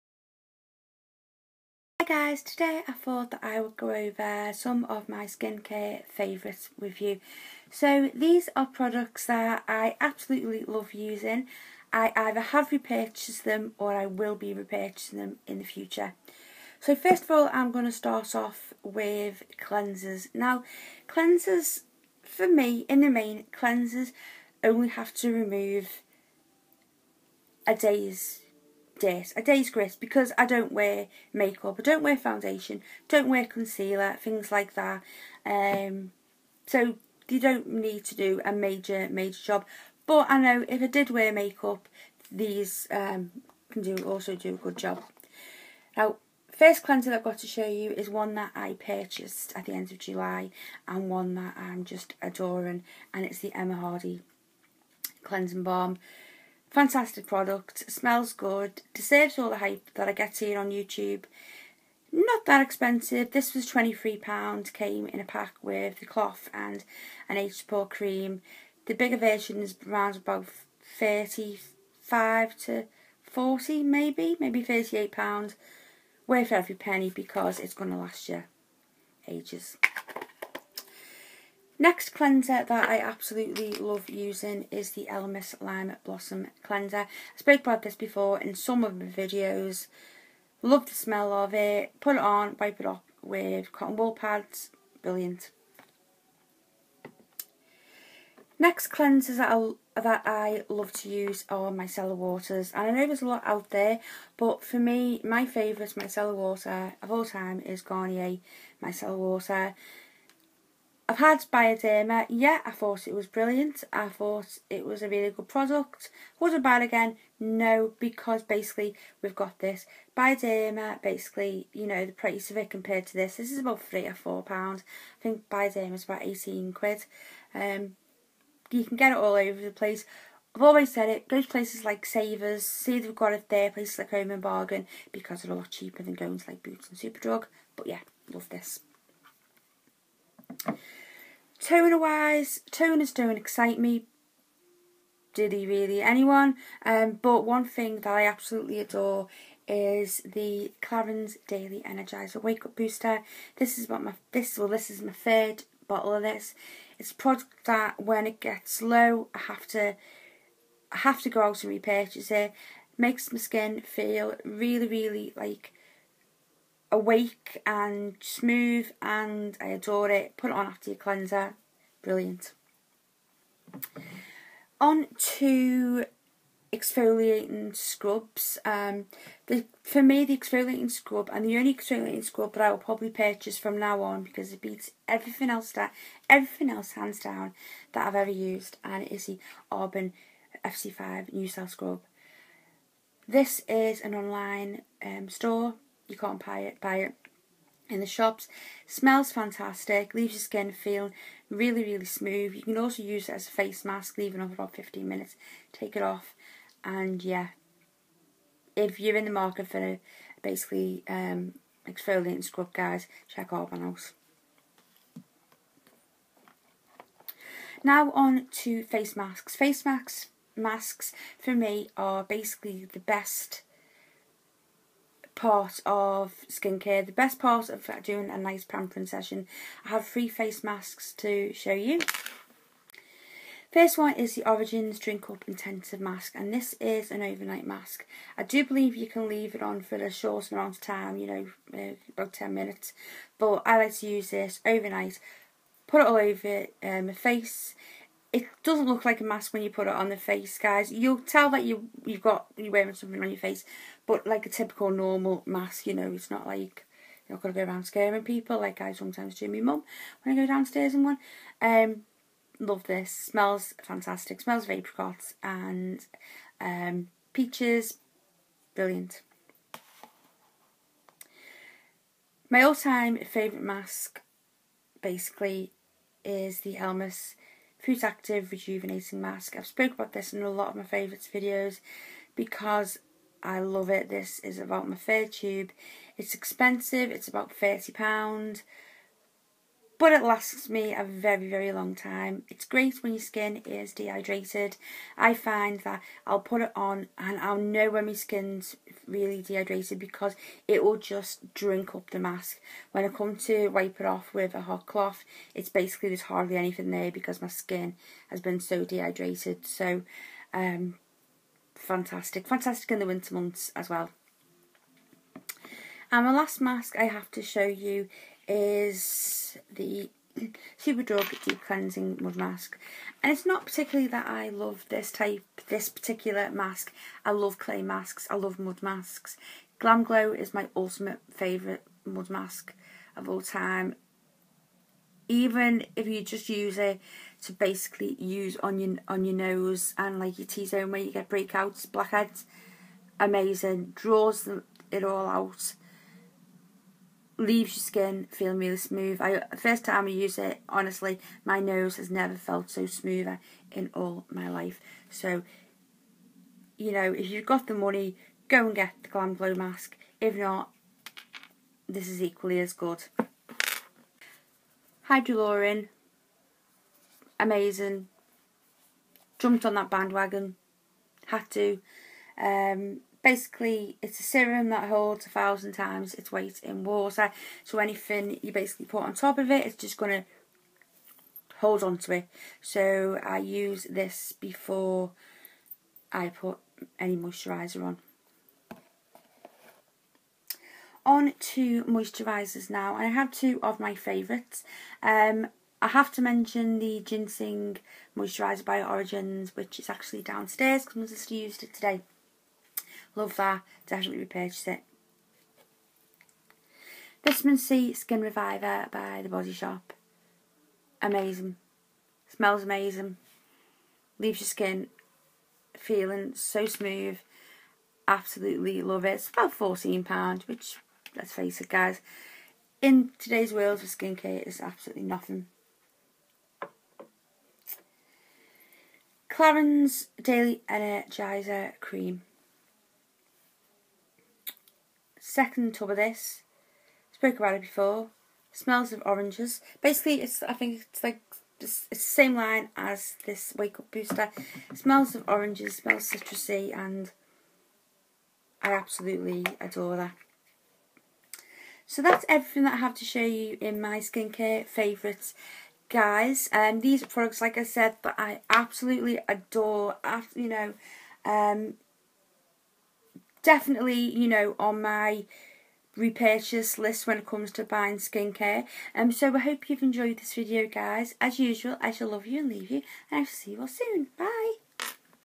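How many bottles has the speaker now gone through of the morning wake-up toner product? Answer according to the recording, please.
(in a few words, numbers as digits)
3.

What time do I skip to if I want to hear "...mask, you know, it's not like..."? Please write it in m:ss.
4:15.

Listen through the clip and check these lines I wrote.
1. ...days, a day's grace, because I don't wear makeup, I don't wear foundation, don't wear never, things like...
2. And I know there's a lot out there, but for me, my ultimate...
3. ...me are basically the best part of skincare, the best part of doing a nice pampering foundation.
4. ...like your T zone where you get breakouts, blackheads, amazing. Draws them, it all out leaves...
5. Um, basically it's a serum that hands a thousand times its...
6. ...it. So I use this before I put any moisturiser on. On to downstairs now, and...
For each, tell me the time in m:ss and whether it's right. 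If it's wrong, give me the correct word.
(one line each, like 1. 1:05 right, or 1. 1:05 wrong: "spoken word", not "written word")
1. 0:29 wrong: "concealer", not "never"
2. 1:42 wrong: "favourite", not "ultimate"
3. 3:41 wrong: "session", not "foundation"
4. 5:40 right
5. 6:12 wrong: "holds", not "hands"
6. 6:22 wrong: "moisturisers", not "downstairs".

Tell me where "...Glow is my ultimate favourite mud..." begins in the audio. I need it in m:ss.
5:30.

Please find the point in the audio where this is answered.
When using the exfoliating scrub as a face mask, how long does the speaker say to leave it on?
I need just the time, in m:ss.
3:24.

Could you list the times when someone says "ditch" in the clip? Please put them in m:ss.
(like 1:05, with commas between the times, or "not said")
not said.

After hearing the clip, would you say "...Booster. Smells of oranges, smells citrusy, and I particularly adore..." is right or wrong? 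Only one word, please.
wrong.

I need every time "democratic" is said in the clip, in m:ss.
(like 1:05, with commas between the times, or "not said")
not said.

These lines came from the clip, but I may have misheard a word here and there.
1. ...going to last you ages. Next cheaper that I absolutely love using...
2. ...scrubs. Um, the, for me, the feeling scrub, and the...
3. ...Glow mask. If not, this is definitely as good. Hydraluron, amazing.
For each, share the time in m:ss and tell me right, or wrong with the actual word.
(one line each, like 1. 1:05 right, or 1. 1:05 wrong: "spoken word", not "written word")
1. 1:17 wrong: "cleanser", not "cheaper"
2. 2:57 wrong: "exfoliating", not "feeling"
3. 5:59 wrong: "equally", not "definitely".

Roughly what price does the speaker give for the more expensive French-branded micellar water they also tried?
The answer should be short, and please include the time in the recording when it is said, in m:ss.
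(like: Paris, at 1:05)
£18, at 2:06.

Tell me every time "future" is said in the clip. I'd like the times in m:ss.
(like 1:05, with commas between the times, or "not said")
0:15.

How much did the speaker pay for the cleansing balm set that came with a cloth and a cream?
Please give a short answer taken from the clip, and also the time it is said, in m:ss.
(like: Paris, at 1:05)
£23, at 1:03.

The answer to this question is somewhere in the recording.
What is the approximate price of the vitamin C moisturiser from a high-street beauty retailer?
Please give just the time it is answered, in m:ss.
6:59.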